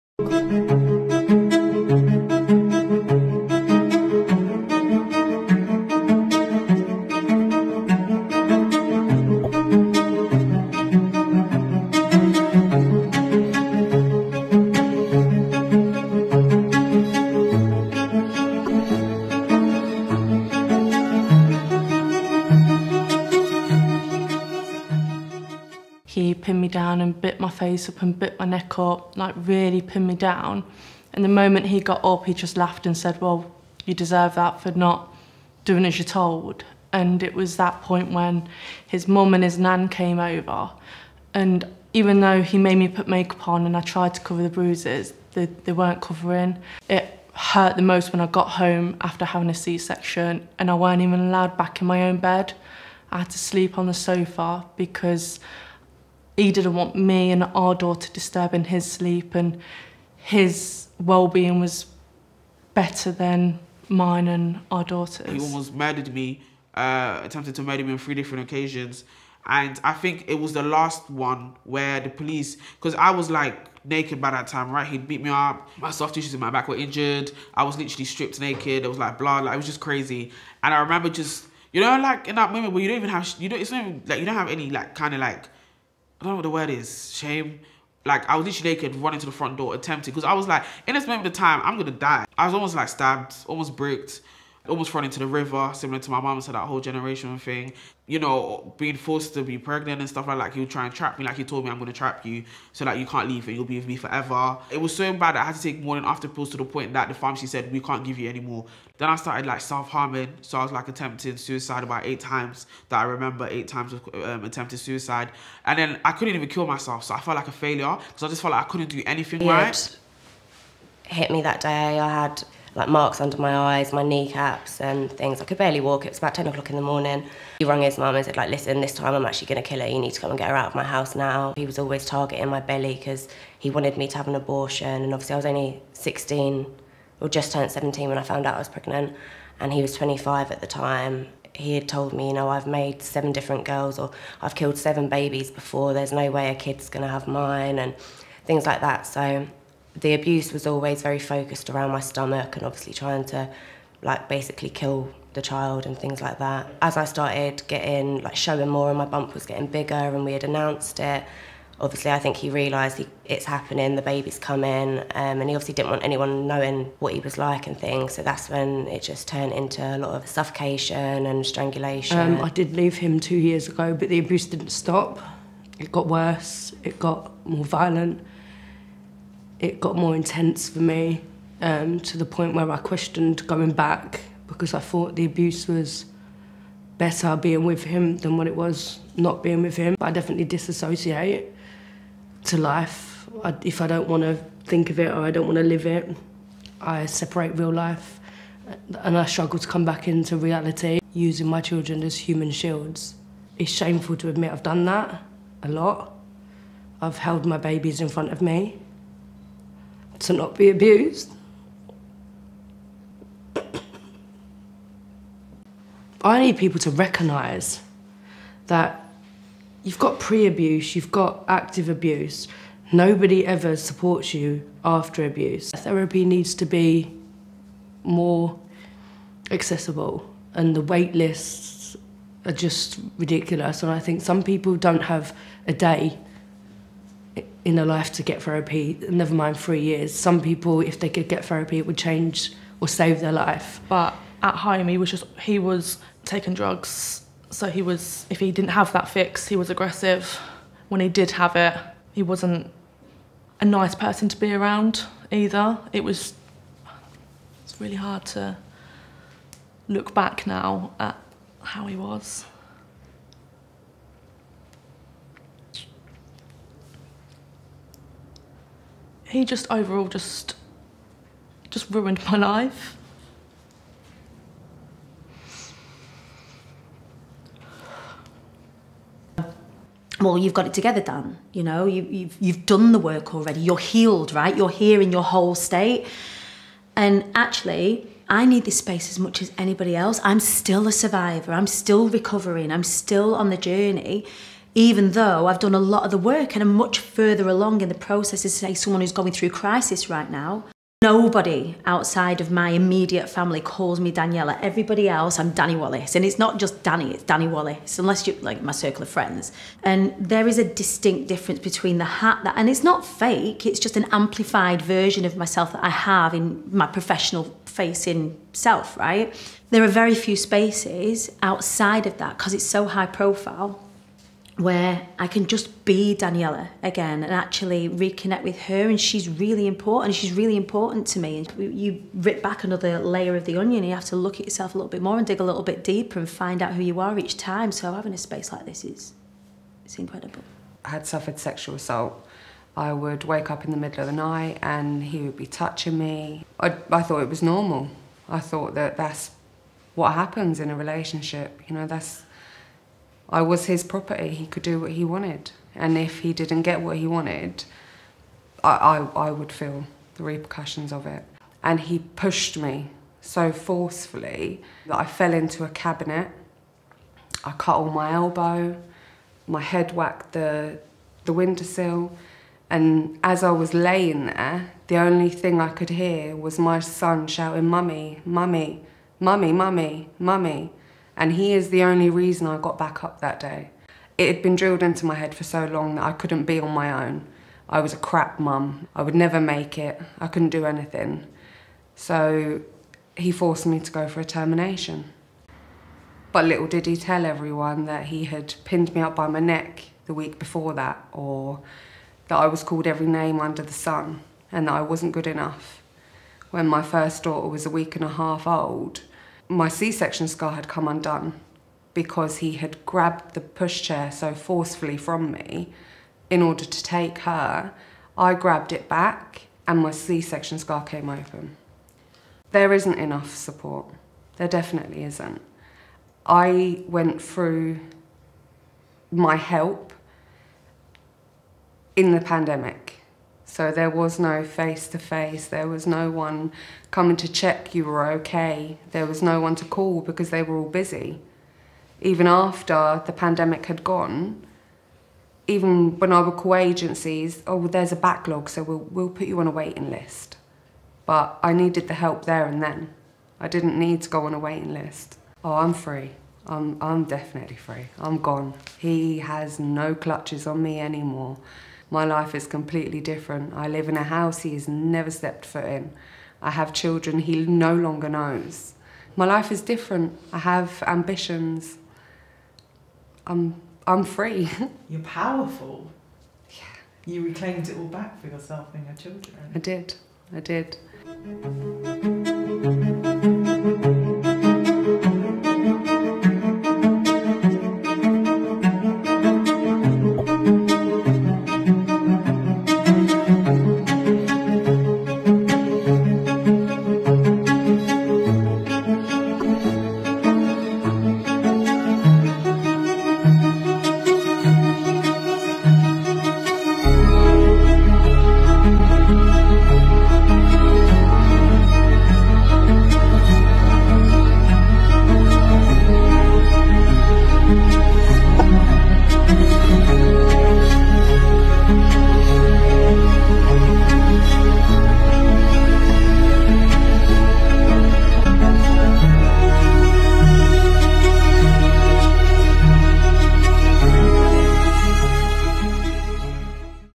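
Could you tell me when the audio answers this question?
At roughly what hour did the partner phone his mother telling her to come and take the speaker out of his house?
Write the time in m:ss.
2:06.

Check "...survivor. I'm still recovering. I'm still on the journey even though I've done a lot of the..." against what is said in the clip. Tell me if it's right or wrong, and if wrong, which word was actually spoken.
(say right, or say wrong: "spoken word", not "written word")
right.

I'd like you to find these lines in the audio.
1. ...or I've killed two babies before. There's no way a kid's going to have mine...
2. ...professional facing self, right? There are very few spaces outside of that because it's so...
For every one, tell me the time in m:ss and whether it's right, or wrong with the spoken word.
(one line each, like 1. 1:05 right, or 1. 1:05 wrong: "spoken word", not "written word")
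1. 2:23 wrong: "seven", not "two"
2. 5:16 right.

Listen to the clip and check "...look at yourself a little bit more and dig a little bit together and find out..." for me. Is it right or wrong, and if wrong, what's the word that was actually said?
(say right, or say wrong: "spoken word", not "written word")
wrong: "deeper", not "together".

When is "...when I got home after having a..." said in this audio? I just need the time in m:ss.
0:48.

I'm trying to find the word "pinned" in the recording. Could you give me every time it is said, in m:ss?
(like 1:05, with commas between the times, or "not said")
0:29, 6:38.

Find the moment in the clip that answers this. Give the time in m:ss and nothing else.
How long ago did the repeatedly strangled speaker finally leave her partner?
2:53.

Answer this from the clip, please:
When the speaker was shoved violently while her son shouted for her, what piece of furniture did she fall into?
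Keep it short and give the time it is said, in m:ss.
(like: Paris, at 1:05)
a cabinet, at 6:05.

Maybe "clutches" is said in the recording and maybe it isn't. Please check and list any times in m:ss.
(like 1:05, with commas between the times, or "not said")
7:39.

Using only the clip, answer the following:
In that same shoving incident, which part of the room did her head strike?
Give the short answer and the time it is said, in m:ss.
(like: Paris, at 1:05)
windowsill, at 6:11.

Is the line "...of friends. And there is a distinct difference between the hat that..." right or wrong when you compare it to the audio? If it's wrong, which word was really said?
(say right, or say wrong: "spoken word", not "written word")
right.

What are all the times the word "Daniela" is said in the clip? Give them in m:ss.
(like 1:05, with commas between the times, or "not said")
5:04, 5:26.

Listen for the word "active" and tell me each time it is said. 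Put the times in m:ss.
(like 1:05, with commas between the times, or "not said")
3:41.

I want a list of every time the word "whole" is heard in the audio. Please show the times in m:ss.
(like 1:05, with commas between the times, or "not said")
1:36, 4:45.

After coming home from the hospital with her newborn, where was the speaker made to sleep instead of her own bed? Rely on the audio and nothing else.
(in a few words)
sofa.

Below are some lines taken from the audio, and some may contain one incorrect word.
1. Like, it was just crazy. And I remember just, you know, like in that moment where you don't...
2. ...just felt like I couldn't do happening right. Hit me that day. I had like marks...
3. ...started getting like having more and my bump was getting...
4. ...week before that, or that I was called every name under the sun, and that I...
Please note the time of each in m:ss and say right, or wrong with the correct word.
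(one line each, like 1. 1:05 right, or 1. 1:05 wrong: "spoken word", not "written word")
1. 1:19 right
2. 1:58 wrong: "anything", not "happening"
3. 2:37 wrong: "showing", not "having"
4. 6:40 right.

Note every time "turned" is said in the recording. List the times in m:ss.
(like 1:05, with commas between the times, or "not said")
2:17, 2:49.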